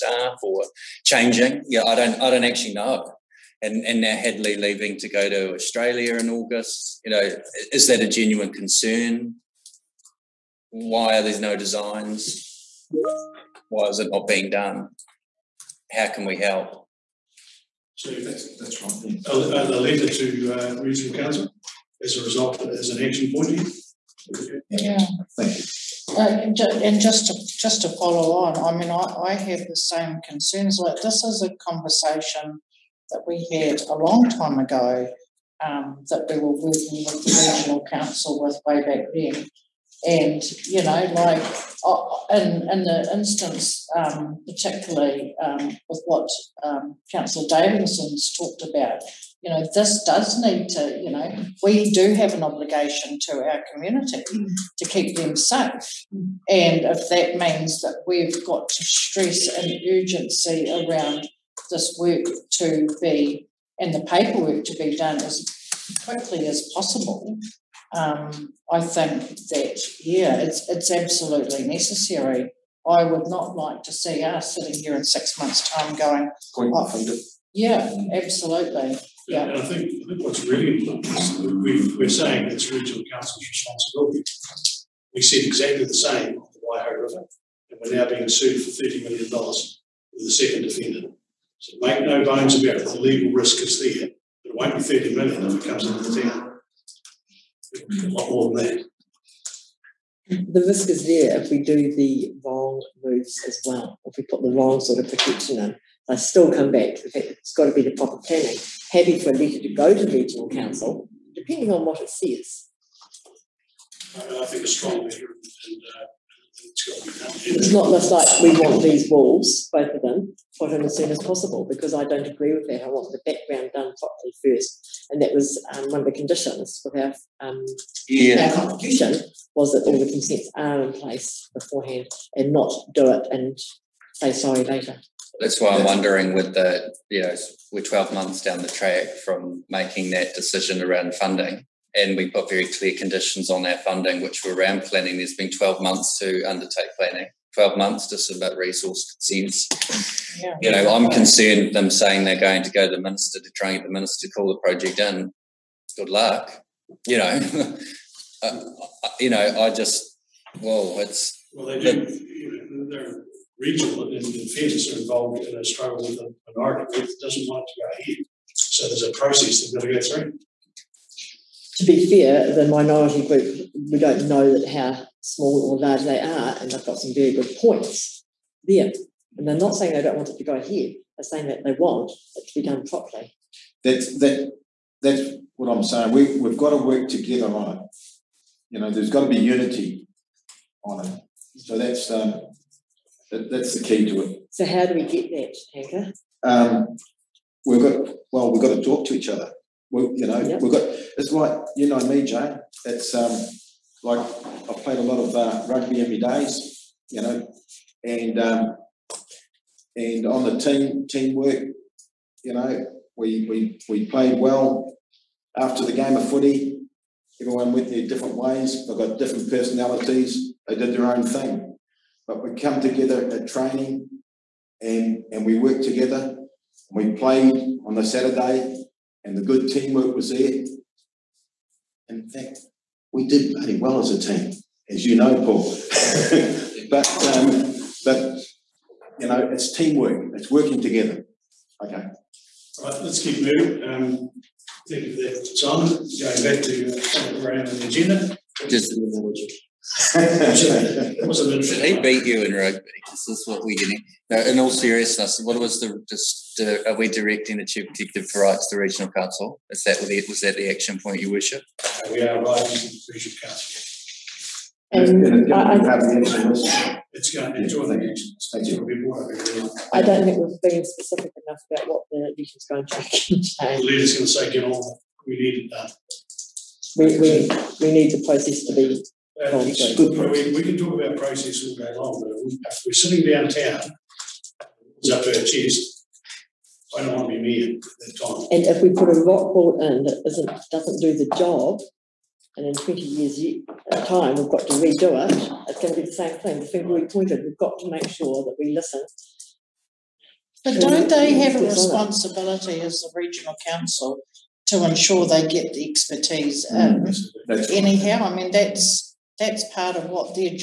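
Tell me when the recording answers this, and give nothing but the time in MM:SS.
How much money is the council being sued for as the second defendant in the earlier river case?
01:28.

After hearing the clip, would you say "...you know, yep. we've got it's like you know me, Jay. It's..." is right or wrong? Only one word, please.
right.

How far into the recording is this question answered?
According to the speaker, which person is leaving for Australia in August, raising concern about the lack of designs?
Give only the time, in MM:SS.
00:04.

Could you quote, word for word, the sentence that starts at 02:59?
And they're not saying they don't want it to go ahead, they're saying that they want it to be done properly.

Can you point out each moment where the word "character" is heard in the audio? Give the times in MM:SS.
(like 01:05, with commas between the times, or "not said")
not said.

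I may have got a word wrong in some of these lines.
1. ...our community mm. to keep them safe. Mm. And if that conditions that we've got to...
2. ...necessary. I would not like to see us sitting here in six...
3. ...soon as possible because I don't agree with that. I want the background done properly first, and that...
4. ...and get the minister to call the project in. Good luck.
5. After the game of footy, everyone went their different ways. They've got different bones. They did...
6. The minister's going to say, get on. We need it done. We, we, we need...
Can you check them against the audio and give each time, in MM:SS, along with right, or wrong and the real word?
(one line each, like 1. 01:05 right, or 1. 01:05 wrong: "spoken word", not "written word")
1. 00:53 wrong: "means", not "conditions"
2. 01:11 right
3. 02:00 right
4. 02:33 right
5. 03:35 wrong: "personalities", not "bones"
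6. 04:33 wrong: "leader", not "minister".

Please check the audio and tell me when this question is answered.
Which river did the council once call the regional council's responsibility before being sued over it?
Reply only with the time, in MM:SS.
01:26.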